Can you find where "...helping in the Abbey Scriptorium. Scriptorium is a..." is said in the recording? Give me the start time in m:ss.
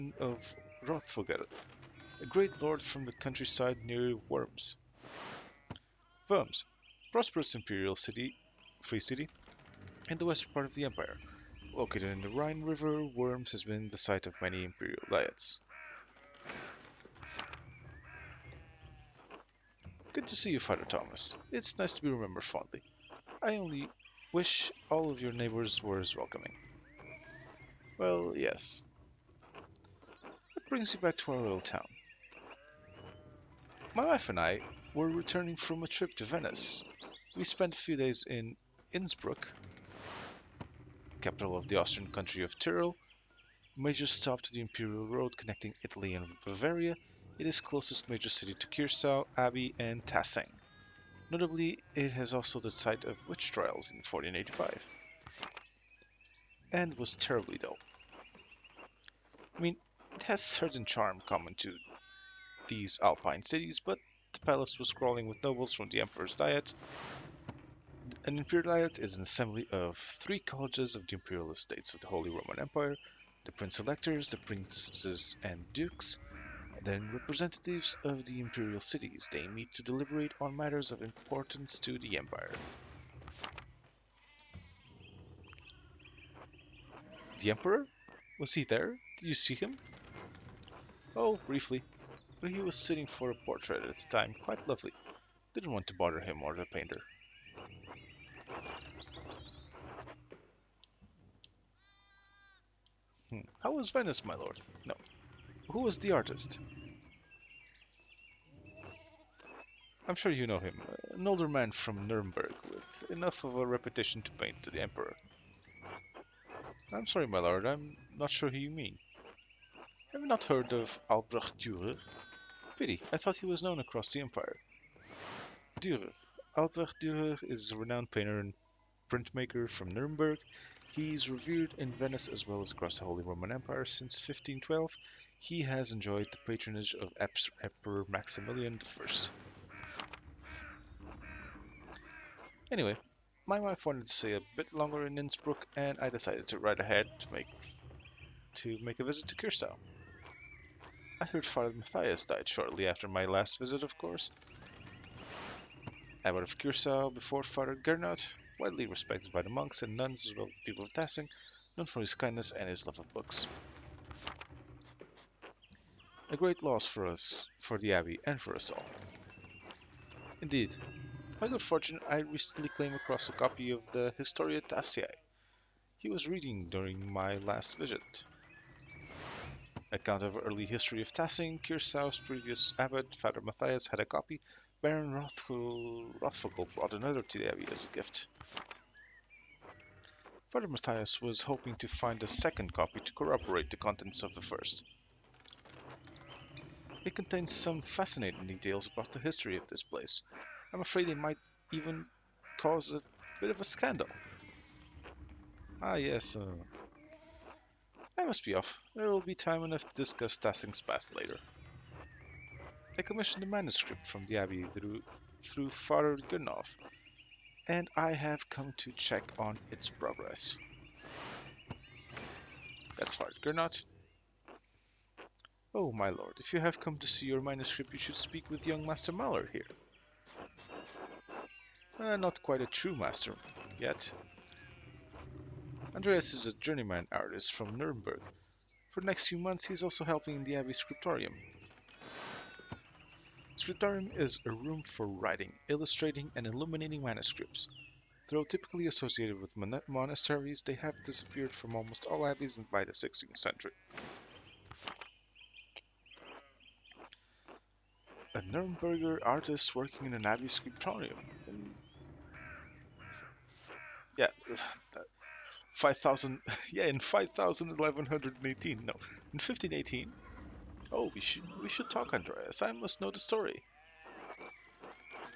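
4:00.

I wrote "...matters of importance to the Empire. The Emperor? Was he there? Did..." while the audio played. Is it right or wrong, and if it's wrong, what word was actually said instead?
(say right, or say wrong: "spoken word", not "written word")
right.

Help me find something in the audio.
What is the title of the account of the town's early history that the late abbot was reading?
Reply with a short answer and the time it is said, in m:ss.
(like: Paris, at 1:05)
Historia Tassiae, at 2:54.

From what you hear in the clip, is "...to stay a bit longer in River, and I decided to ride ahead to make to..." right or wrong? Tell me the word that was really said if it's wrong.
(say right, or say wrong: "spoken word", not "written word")
wrong: "Innsbruck", not "River".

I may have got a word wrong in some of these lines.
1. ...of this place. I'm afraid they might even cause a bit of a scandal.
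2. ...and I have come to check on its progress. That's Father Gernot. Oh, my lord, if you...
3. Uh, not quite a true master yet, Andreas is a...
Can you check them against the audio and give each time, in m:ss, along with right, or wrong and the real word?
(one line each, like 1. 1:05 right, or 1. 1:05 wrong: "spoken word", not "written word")
1. 3:19 right
2. 3:37 right
3. 3:51 right.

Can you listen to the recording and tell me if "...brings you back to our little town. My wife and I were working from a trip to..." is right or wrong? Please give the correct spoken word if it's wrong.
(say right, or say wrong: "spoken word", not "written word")
wrong: "returning", not "working".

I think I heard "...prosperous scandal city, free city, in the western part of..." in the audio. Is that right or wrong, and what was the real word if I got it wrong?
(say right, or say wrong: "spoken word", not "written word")
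wrong: "imperial", not "scandal".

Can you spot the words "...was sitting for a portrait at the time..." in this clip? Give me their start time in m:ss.
1:32.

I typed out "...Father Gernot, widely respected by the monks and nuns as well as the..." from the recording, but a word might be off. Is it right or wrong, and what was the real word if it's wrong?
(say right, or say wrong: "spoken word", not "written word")
right.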